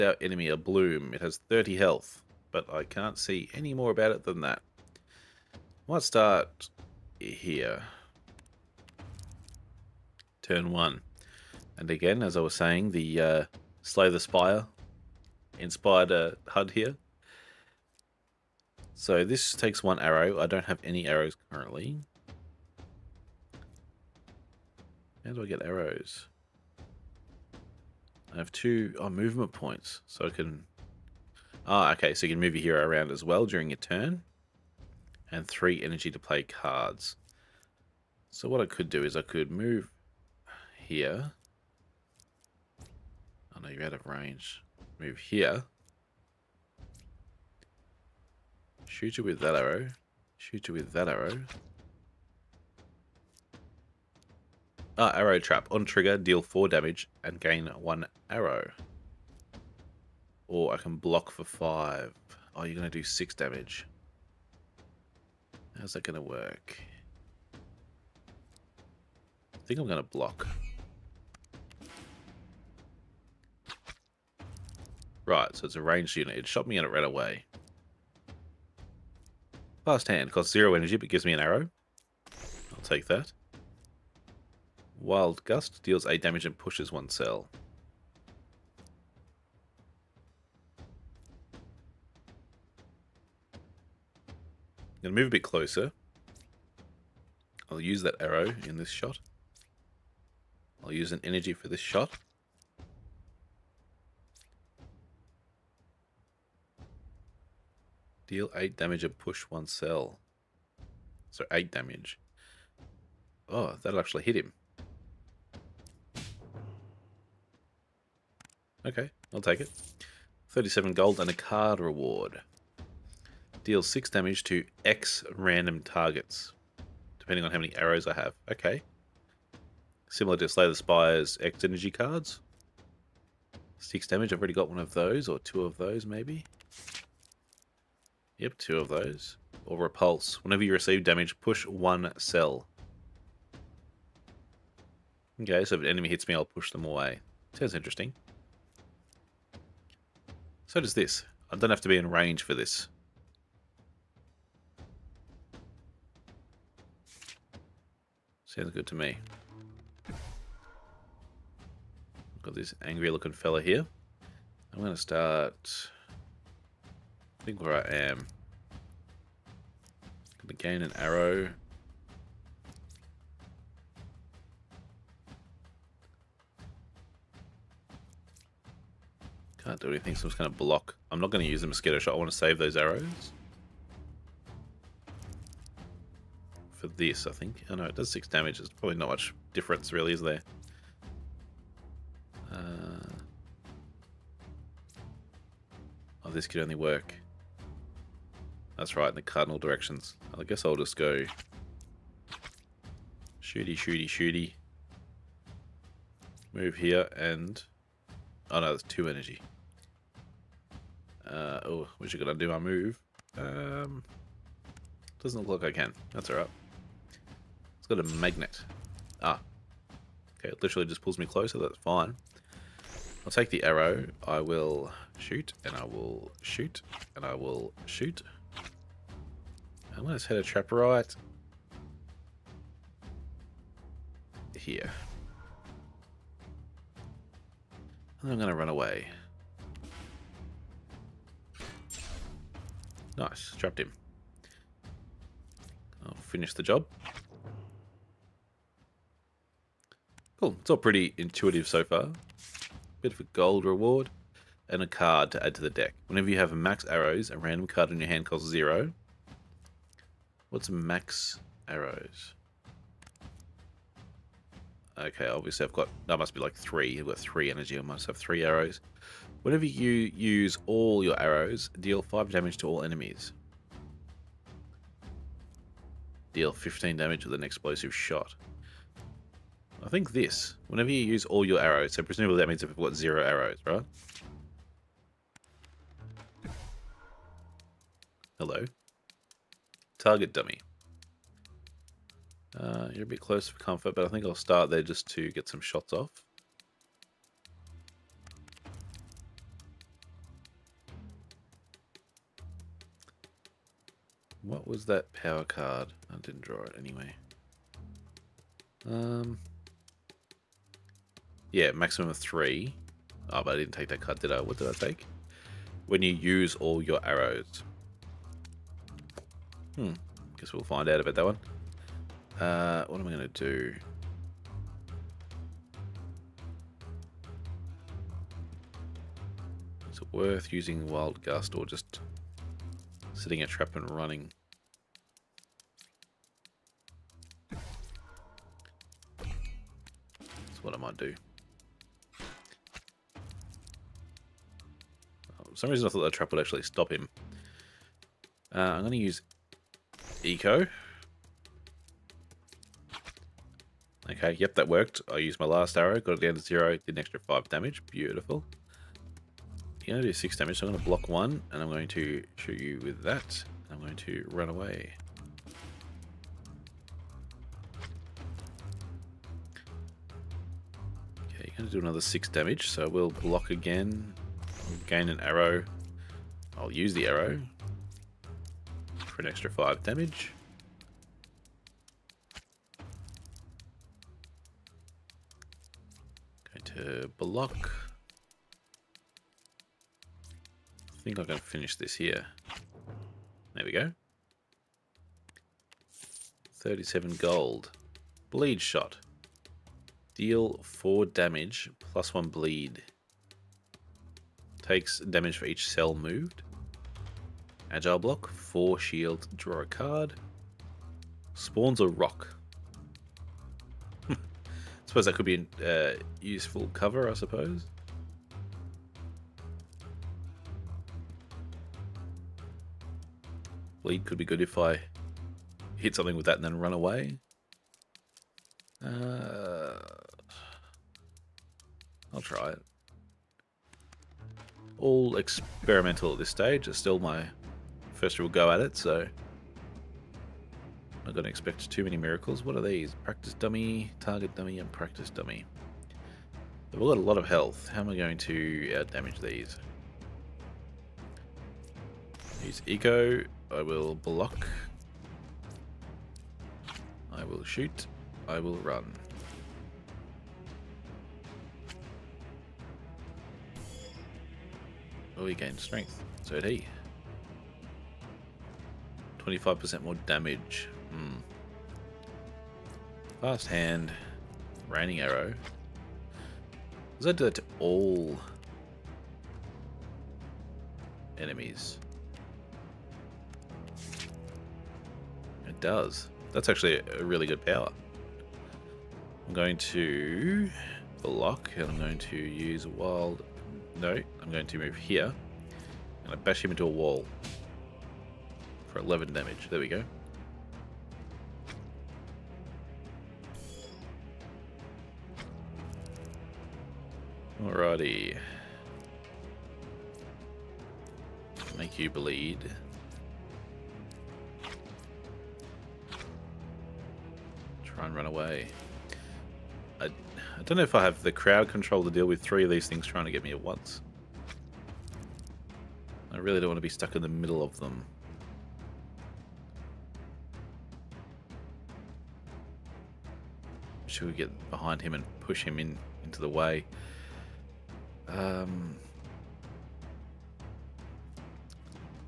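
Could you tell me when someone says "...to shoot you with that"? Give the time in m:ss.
6:01.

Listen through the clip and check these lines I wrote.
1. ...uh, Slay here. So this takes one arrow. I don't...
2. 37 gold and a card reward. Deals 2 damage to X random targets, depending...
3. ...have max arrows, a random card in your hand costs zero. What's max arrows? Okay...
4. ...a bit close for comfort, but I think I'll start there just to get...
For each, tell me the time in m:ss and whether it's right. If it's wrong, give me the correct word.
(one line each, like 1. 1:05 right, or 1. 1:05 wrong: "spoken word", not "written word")
1. 0:16 wrong: "HUD", not "Slay"
2. 2:00 wrong: "6", not "2"
3. 4:16 right
4. 4:53 right.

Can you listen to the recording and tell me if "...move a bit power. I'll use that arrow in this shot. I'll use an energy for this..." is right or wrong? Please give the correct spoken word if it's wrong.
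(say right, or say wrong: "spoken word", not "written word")
wrong: "closer", not "power".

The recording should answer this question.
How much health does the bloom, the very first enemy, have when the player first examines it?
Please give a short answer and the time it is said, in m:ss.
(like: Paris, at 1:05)
30, at 0:01.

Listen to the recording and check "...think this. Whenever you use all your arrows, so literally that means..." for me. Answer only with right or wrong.
wrong.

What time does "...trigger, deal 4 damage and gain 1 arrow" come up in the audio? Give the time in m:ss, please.
0:55.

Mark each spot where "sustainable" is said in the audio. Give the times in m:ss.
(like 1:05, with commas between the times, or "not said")
not said.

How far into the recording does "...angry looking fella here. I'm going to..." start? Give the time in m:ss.
2:42.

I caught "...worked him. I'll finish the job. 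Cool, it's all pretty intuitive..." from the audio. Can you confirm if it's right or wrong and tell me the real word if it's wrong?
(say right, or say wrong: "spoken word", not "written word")
wrong: "trapped", not "worked".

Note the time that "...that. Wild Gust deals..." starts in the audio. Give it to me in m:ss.
1:23.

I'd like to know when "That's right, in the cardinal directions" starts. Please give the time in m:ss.
3:18.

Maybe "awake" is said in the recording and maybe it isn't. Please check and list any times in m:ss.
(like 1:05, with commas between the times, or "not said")
not said.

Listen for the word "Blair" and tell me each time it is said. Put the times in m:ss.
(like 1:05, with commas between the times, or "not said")
not said.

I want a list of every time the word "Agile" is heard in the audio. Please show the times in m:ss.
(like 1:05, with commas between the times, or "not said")
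6:47.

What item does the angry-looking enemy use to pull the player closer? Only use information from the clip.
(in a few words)
A magnet.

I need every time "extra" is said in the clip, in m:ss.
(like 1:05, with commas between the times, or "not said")
5:56, 6:19.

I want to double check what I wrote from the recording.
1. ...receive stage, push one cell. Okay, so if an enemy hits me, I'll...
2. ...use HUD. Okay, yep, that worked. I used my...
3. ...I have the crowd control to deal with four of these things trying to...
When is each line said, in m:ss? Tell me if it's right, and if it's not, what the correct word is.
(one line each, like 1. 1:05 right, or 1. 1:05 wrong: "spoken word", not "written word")
1. 2:20 wrong: "damage", not "stage"
2. 5:48 wrong: "Eco", not "HUD"
3. 8:40 wrong: "three", not "four".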